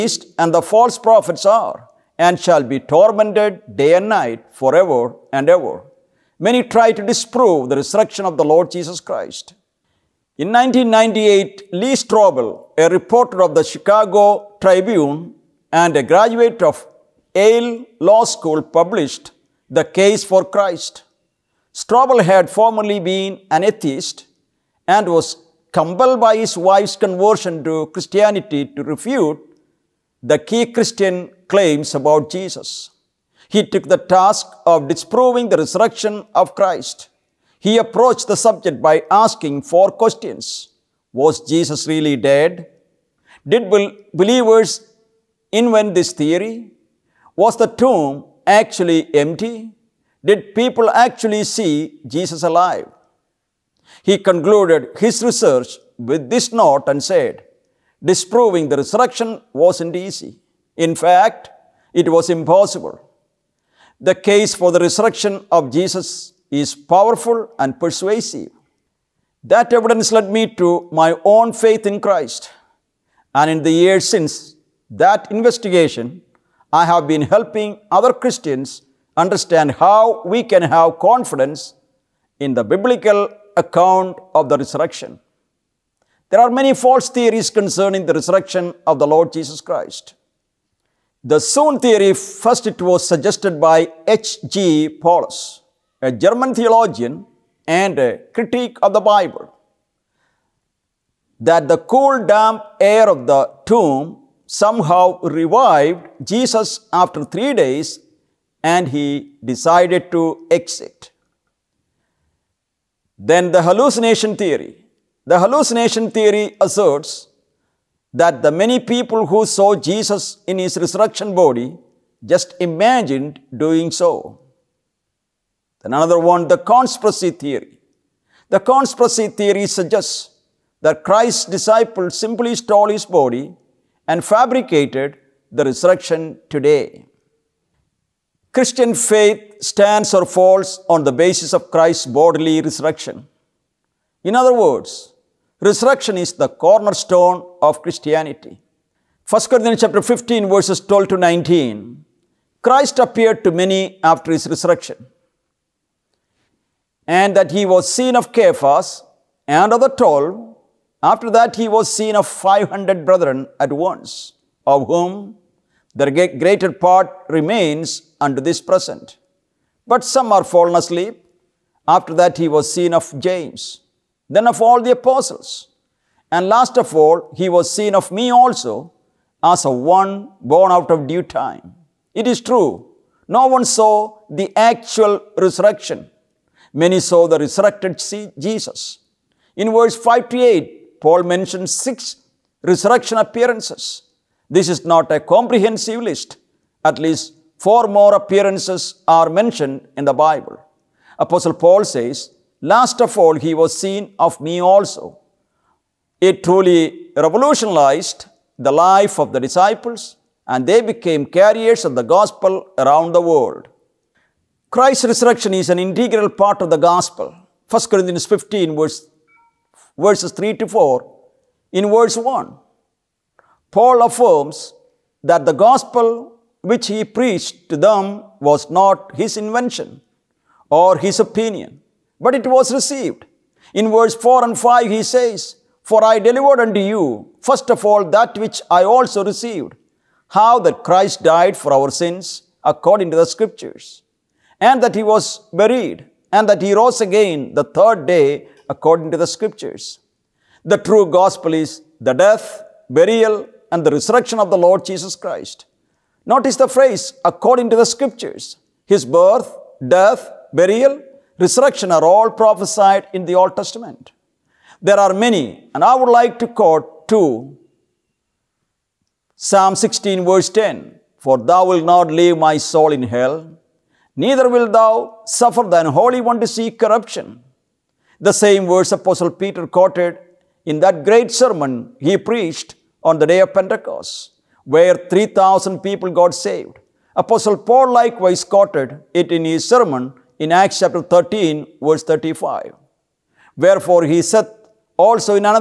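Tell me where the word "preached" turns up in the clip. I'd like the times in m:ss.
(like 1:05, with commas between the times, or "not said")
3:47, 4:42.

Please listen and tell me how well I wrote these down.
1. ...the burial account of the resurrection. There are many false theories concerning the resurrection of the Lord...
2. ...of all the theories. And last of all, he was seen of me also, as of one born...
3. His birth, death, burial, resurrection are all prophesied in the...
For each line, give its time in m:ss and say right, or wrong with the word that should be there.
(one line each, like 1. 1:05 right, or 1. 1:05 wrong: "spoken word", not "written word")
1. 1:22 wrong: "biblical", not "burial"
2. 2:54 wrong: "apostles", not "theories"
3. 4:18 right.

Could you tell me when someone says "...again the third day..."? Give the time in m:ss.
4:06.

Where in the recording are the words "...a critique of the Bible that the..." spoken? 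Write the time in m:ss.
1:37.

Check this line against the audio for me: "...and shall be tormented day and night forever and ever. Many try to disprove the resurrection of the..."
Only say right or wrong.
right.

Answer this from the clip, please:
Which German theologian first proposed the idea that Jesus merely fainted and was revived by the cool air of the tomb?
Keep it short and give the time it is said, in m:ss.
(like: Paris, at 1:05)
H.G. Paulus, at 1:34.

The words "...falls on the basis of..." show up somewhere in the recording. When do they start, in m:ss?
2:20.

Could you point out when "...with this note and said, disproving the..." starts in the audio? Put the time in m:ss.
0:56.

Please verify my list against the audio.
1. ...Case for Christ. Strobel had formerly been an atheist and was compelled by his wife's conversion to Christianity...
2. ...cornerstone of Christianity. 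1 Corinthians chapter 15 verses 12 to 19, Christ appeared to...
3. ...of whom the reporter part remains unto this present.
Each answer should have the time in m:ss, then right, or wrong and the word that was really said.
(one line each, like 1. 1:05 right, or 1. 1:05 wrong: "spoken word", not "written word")
1. 0:19 right
2. 2:26 right
3. 2:44 wrong: "greater", not "reporter".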